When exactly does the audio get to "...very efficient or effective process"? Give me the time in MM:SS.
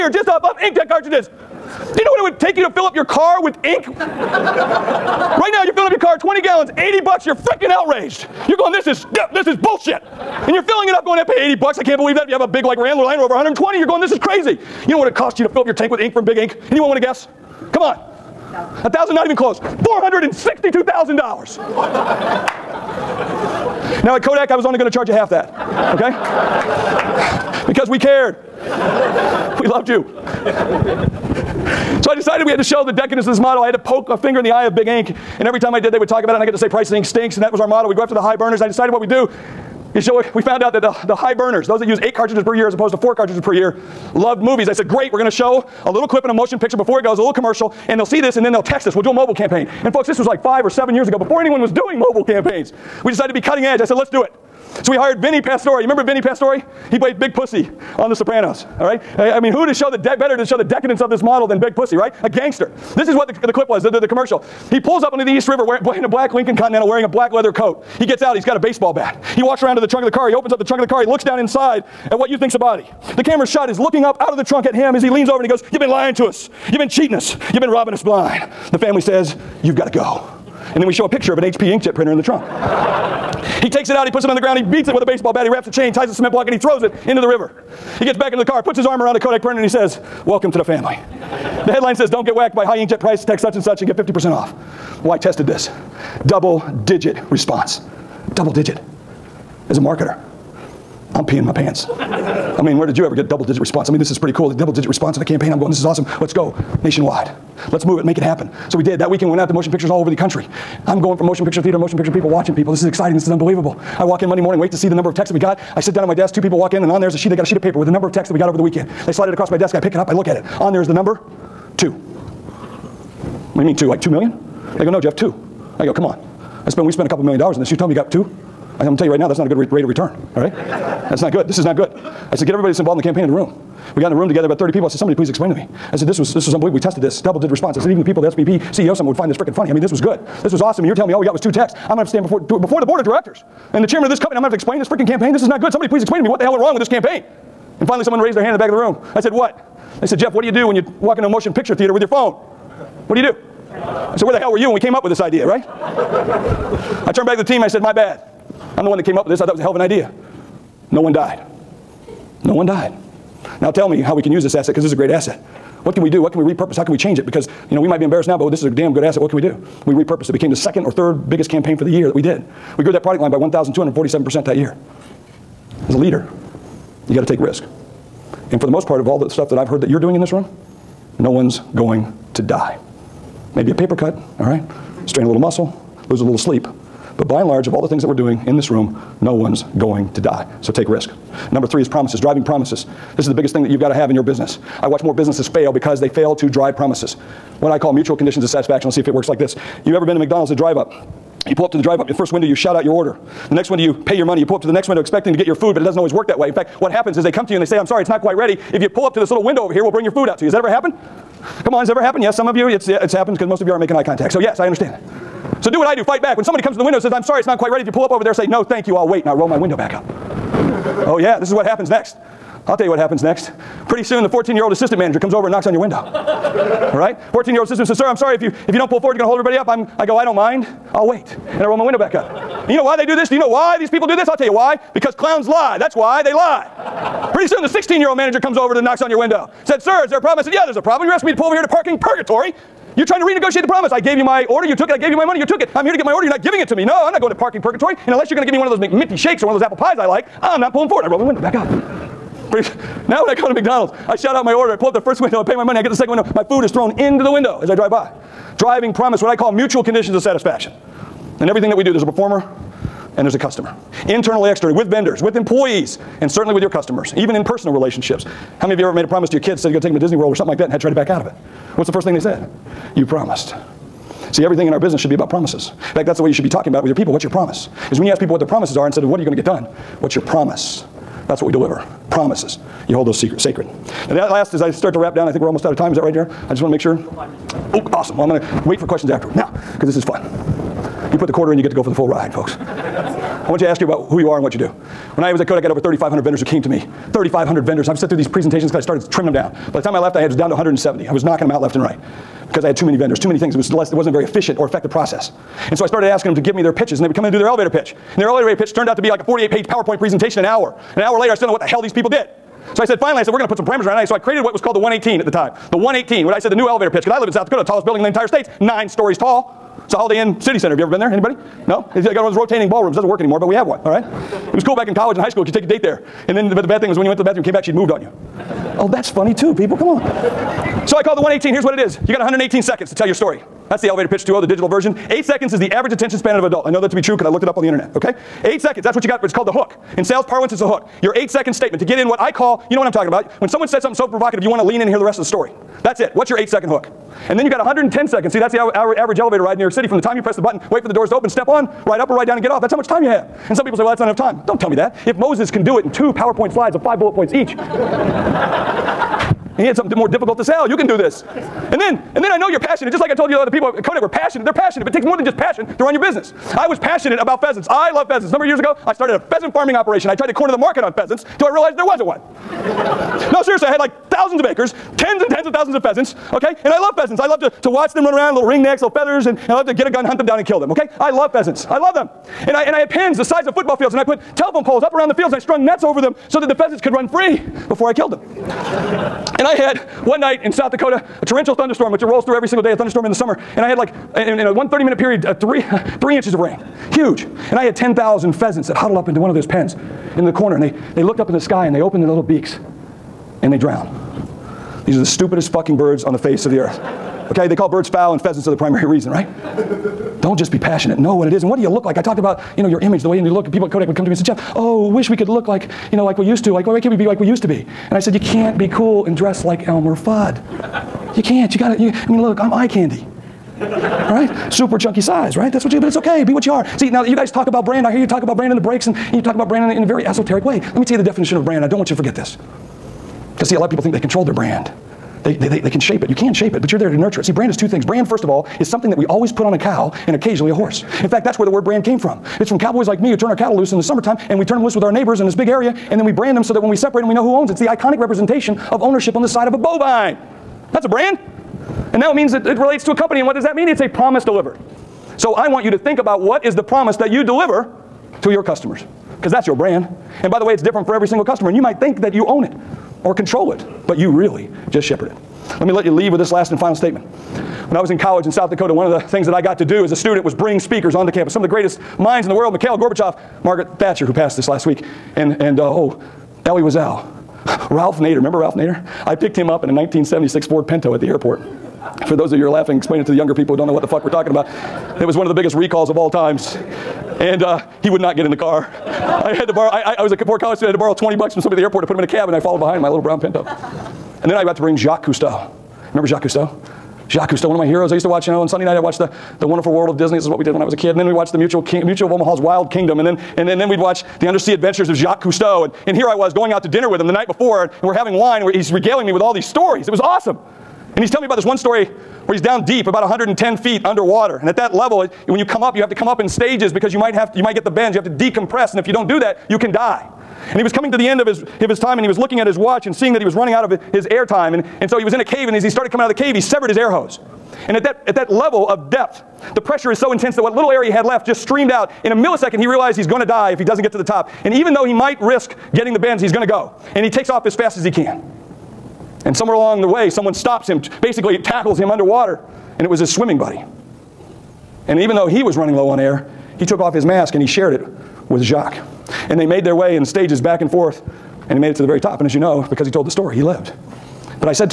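05:04.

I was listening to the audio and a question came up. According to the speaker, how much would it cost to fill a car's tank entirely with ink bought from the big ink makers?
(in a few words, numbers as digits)
$462,000.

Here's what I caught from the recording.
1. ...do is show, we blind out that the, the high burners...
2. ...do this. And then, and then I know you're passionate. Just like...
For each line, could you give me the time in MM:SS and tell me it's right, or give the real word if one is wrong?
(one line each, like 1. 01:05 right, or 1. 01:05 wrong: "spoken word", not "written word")
1. 00:39 wrong: "found", not "blind"
2. 06:00 right.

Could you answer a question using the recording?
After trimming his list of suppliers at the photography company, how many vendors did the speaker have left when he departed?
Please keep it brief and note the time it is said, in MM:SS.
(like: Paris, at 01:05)
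170, at 05:00.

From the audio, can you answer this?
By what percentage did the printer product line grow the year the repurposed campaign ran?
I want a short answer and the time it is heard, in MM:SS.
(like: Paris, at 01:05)
1,247%, at 02:53.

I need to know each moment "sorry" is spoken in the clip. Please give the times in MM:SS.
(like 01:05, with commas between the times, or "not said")
03:27, 03:37, 03:48.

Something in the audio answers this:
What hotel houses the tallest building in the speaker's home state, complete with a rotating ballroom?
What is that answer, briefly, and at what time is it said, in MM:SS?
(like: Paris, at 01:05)
Holiday Inn City Center, at 05:19.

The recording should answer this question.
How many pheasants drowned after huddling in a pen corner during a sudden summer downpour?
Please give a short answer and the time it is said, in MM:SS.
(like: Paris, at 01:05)
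10,000, at 06:37.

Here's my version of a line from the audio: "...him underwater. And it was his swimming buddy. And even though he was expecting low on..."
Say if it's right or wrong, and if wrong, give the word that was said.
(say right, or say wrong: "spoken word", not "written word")
wrong: "running", not "expecting".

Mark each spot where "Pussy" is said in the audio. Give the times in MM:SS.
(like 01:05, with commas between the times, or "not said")
00:57, 01:01.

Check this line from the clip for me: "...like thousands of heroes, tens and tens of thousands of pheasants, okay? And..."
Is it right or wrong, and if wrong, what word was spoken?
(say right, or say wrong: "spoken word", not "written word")
wrong: "acres", not "heroes".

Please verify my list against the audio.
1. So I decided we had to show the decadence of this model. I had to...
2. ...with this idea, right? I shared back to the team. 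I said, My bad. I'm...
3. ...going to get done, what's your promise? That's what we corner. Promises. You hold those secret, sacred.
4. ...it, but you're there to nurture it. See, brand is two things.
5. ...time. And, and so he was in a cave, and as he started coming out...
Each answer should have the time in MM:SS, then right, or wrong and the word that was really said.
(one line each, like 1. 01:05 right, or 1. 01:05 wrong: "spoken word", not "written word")
1. 00:32 right
2. 02:35 wrong: "turned", not "shared"
3. 04:39 wrong: "deliver", not "corner"
4. 07:16 right
5. 08:44 right.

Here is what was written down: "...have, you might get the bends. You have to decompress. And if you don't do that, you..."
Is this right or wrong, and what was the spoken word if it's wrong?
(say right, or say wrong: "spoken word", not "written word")
right.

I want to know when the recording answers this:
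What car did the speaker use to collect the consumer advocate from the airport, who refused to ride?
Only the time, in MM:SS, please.
08:00.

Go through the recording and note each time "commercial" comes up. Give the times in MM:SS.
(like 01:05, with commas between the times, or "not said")
00:47, 01:04.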